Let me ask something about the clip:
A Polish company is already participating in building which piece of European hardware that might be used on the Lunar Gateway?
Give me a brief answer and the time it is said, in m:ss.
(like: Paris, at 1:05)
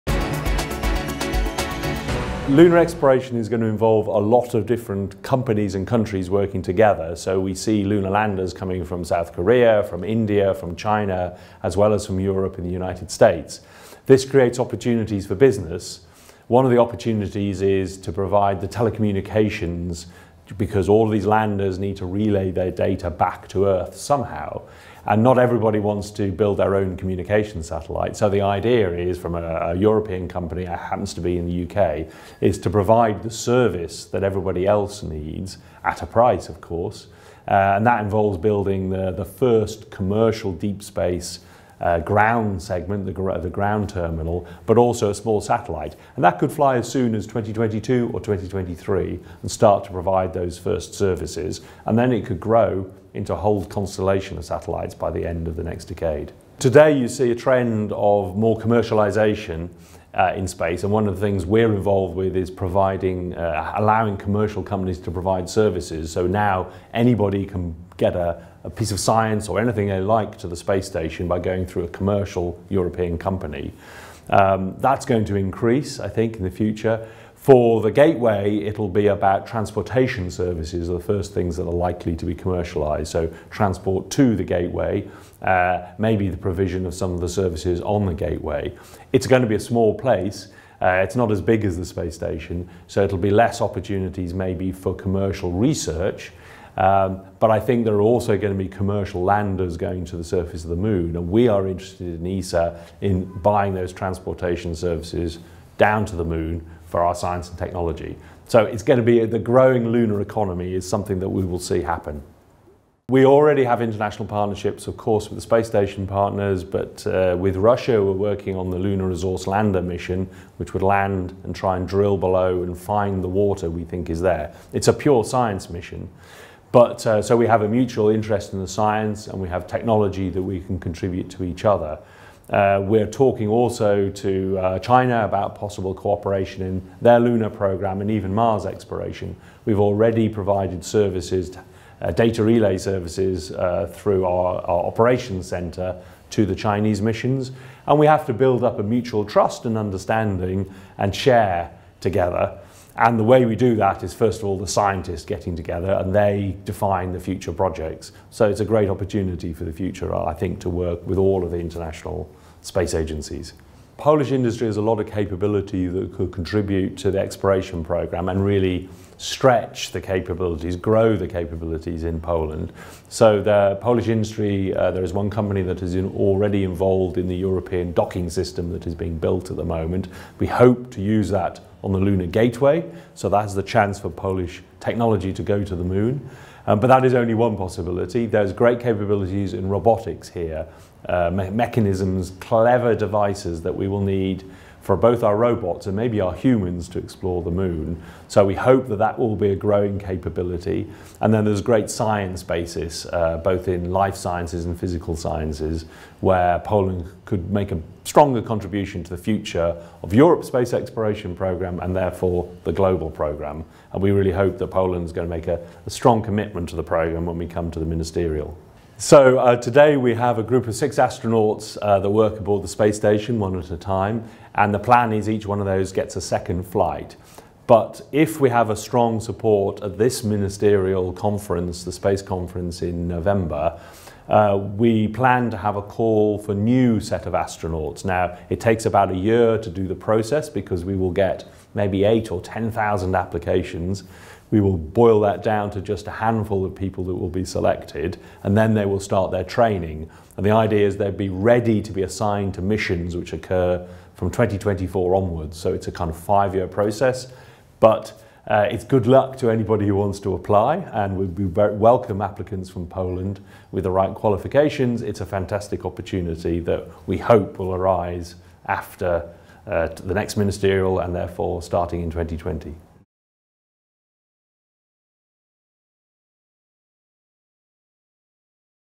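European docking system, at 2:57.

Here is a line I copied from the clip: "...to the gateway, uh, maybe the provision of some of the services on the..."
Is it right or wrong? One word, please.
right.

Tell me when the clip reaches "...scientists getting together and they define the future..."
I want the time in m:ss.
2:34.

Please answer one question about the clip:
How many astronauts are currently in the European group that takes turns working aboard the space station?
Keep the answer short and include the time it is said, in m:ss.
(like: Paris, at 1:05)
6, at 3:40.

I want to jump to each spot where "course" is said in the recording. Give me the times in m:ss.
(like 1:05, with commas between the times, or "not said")
0:36, 1:54.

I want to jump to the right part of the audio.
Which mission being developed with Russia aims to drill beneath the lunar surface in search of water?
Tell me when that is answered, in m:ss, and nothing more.
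1:58.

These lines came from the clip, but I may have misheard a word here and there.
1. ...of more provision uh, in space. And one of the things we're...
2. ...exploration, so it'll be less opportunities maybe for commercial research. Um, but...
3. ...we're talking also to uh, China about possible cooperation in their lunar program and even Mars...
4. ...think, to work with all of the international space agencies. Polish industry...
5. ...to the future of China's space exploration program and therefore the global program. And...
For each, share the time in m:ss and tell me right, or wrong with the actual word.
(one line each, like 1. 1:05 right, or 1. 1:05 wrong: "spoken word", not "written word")
1. 0:57 wrong: "commercialization", not "provision"
2. 1:32 wrong: "station", not "exploration"
3. 2:12 right
4. 2:40 right
5. 3:29 wrong: "Europe", not "China".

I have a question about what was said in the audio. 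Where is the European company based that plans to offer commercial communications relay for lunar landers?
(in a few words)
UK.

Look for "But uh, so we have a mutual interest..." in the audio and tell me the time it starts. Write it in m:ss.
2:06.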